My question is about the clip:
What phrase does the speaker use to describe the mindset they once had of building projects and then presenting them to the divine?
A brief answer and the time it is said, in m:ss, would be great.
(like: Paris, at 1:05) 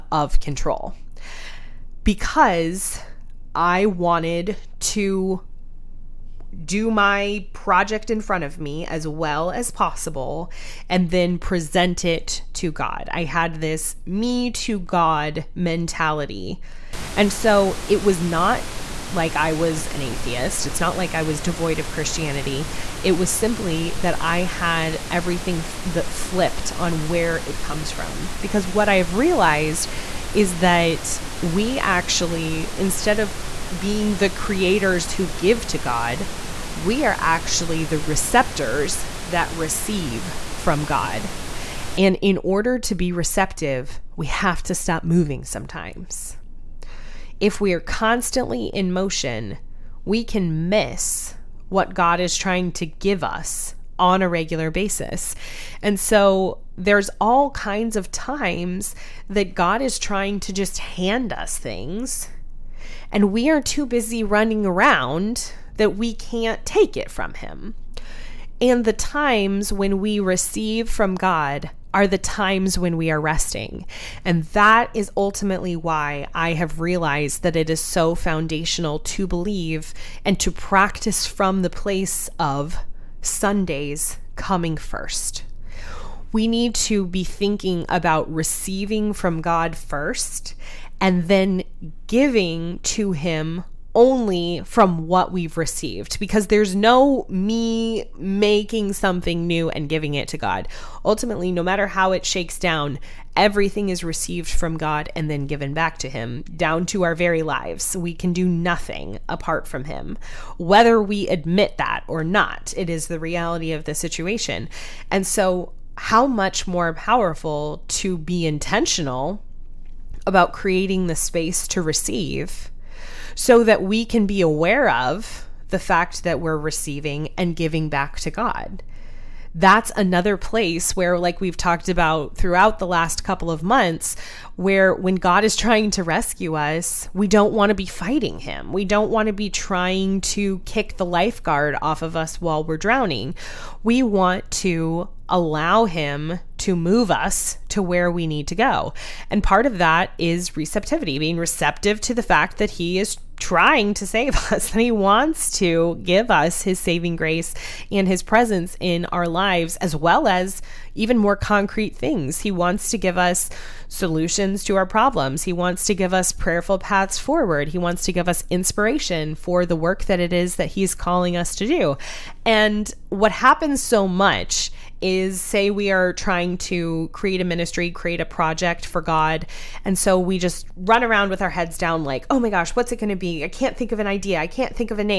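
me to God mentality, at 0:14.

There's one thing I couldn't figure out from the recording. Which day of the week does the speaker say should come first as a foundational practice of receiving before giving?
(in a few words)
Sundays.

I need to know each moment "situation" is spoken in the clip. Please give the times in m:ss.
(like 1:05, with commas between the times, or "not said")
1:53.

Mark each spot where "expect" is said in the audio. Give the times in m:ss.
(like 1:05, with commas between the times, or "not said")
not said.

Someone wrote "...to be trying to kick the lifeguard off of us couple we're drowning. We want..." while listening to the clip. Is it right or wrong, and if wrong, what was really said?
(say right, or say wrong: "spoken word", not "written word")
wrong: "while", not "couple".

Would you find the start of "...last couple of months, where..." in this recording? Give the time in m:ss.
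2:12.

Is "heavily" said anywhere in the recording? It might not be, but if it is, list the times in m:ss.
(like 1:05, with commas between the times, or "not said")
not said.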